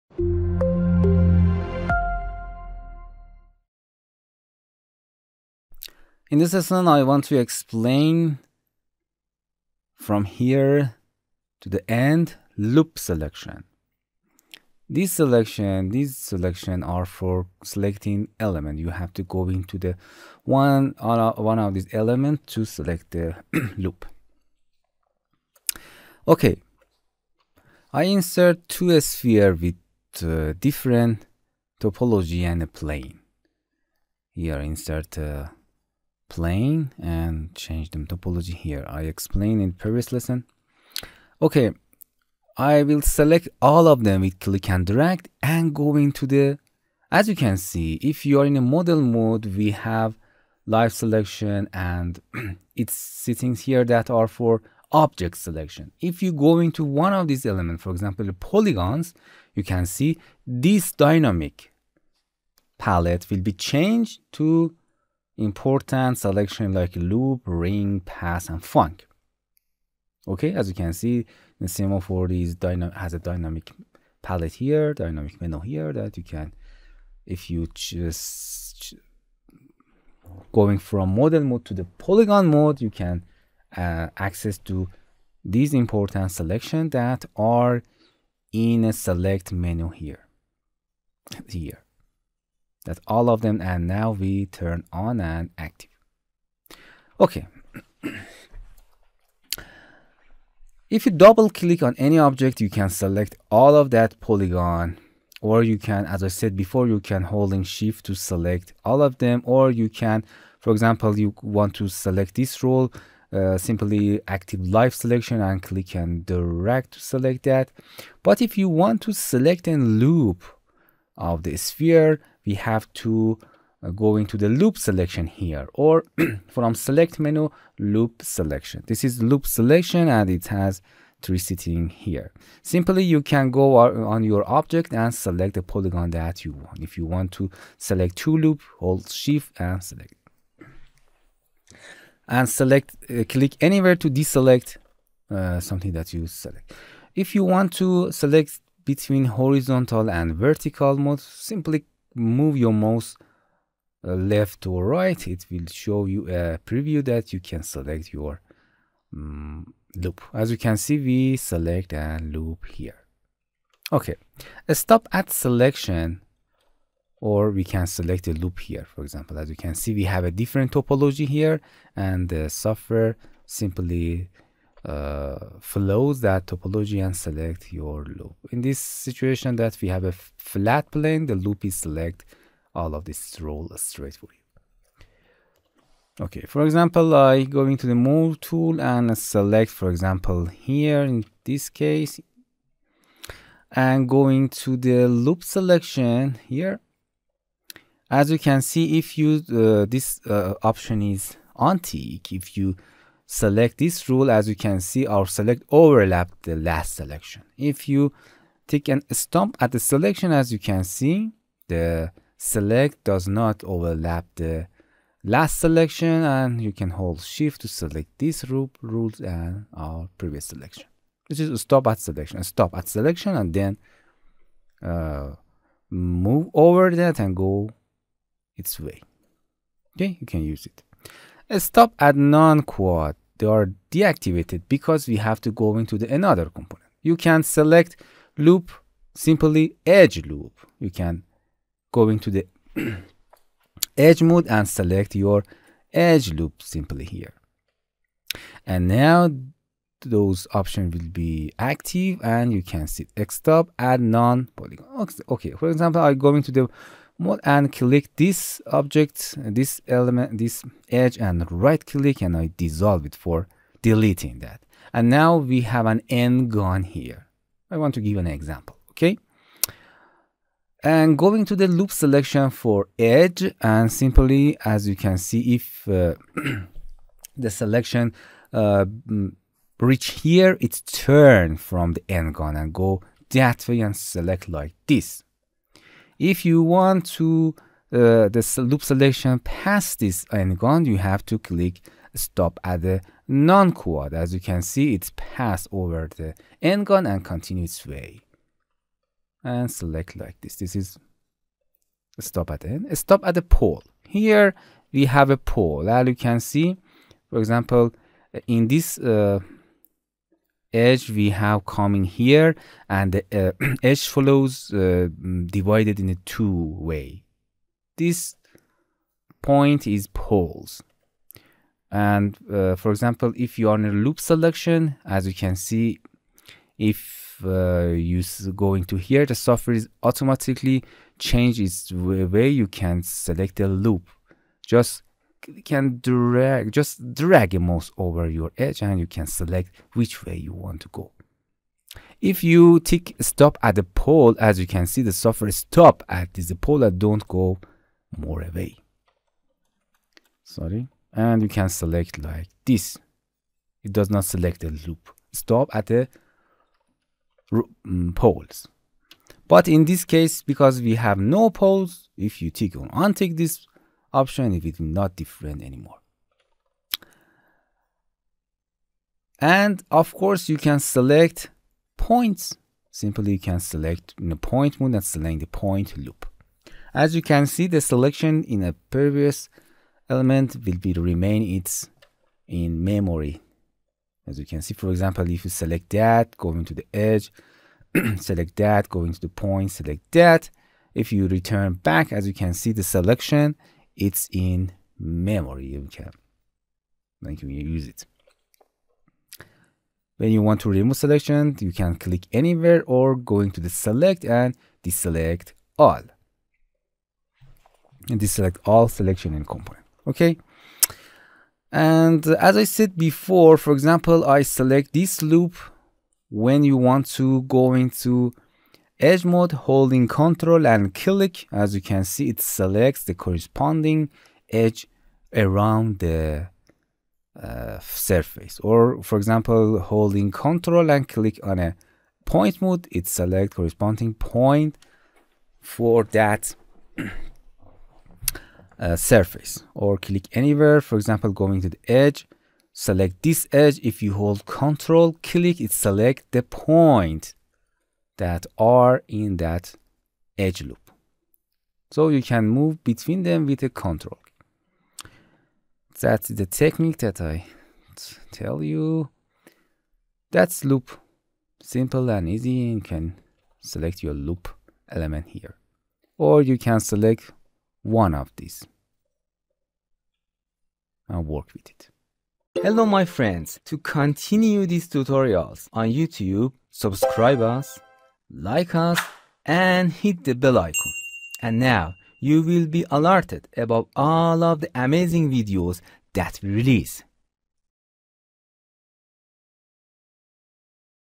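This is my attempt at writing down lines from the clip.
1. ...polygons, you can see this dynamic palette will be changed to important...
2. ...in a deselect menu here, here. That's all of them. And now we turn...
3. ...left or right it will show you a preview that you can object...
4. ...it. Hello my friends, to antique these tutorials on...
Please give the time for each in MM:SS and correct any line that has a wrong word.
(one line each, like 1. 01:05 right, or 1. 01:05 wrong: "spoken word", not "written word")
1. 00:58 right
2. 01:28 wrong: "select", not "deselect"
3. 02:34 wrong: "select", not "object"
4. 07:51 wrong: "continue", not "antique".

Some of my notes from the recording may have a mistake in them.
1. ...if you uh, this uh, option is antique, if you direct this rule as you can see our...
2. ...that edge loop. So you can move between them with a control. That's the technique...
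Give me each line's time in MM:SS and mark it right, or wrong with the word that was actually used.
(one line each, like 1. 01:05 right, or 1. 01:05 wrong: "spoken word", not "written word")
1. 03:18 wrong: "select", not "direct"
2. 07:29 right.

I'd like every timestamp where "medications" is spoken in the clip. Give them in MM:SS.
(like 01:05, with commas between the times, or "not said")
not said.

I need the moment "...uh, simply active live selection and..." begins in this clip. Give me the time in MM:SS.
01:53.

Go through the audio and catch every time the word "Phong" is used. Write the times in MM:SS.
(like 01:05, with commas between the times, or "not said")
01:08.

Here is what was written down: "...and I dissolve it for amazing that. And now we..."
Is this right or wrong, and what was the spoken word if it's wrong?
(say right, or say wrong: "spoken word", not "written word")
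wrong: "deleting", not "amazing".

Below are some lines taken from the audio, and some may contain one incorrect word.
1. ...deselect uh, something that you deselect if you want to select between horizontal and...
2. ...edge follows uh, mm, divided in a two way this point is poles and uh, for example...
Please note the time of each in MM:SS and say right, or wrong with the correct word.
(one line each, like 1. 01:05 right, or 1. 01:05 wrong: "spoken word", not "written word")
1. 02:24 wrong: "select", not "deselect"
2. 05:13 right.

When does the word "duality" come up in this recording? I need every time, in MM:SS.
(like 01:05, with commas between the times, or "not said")
not said.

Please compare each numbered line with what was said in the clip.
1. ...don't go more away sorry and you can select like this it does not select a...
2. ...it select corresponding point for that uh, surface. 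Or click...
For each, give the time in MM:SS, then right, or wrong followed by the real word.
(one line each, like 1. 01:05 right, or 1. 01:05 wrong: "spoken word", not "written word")
1. 05:46 right
2. 07:12 right.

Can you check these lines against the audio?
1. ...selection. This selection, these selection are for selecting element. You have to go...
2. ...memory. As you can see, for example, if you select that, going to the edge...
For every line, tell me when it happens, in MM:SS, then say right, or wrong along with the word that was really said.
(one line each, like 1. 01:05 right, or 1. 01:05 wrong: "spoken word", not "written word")
1. 00:12 right
2. 06:22 right.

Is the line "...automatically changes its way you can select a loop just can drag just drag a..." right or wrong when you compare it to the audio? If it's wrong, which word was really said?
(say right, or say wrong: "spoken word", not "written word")
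right.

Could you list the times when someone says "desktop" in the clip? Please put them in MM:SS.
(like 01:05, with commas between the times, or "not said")
04:13.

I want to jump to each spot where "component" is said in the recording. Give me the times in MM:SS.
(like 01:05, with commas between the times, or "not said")
03:56, 06:49.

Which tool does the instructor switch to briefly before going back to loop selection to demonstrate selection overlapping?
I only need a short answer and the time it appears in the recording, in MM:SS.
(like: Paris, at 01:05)
Move tool, at 03:07.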